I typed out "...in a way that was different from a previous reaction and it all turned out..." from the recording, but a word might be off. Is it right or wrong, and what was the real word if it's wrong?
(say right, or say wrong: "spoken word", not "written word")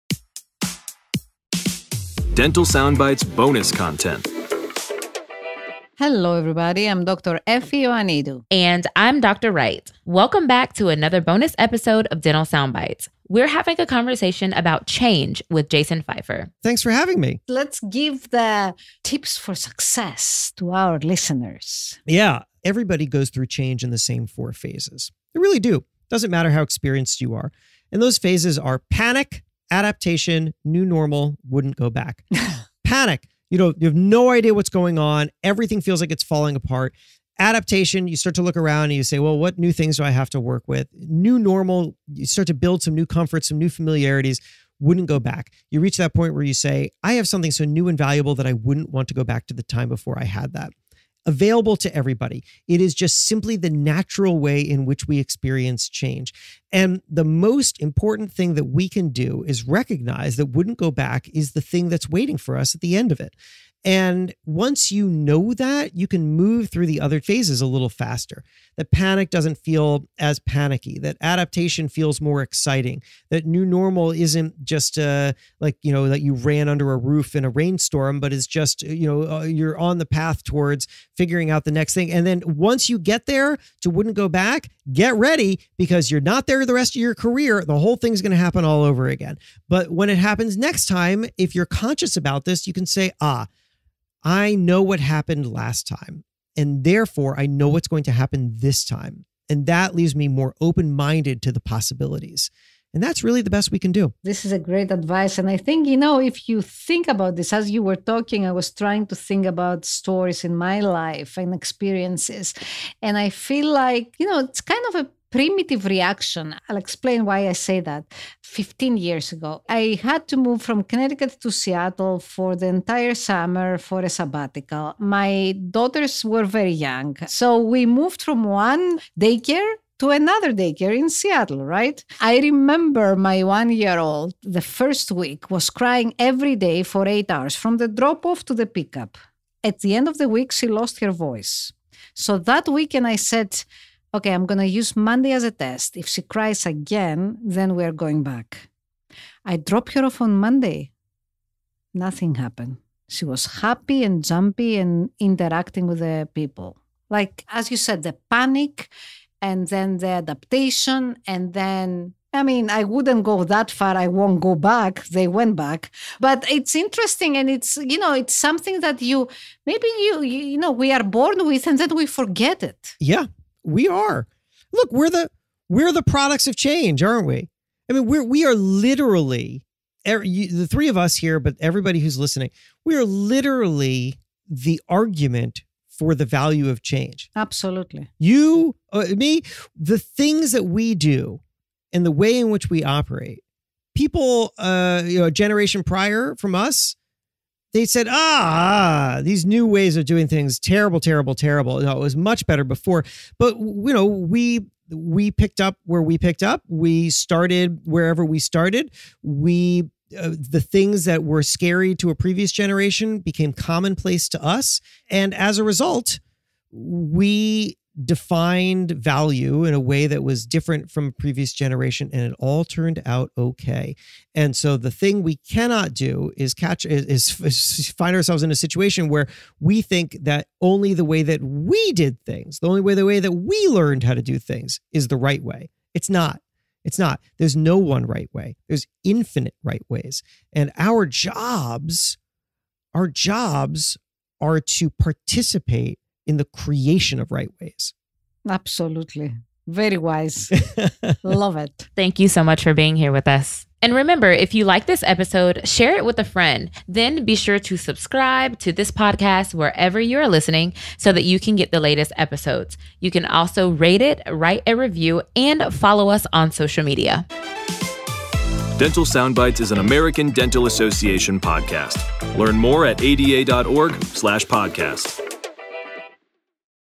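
wrong: "generation", not "reaction".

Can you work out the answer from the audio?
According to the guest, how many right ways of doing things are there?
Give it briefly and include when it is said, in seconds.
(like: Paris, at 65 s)
Infinite, at 239 s.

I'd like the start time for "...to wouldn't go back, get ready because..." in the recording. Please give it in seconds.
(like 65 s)
83 s.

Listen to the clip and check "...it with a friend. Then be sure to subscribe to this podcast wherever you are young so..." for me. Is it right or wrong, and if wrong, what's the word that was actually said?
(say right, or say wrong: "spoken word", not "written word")
wrong: "listening", not "young".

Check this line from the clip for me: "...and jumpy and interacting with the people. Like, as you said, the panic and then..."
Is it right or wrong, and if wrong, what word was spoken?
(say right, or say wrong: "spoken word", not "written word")
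right.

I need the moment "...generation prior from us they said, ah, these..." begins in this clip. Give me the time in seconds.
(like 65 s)
195 s.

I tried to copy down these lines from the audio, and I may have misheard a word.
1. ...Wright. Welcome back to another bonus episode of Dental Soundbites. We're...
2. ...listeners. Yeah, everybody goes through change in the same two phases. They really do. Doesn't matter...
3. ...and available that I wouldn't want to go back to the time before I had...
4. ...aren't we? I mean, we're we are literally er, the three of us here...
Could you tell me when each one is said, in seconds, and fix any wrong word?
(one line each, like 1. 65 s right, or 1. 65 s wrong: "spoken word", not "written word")
1. 9 s right
2. 20 s wrong: "four", not "two"
3. 47 s wrong: "valuable", not "available"
4. 177 s right.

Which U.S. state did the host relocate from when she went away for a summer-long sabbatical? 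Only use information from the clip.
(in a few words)
Connecticut.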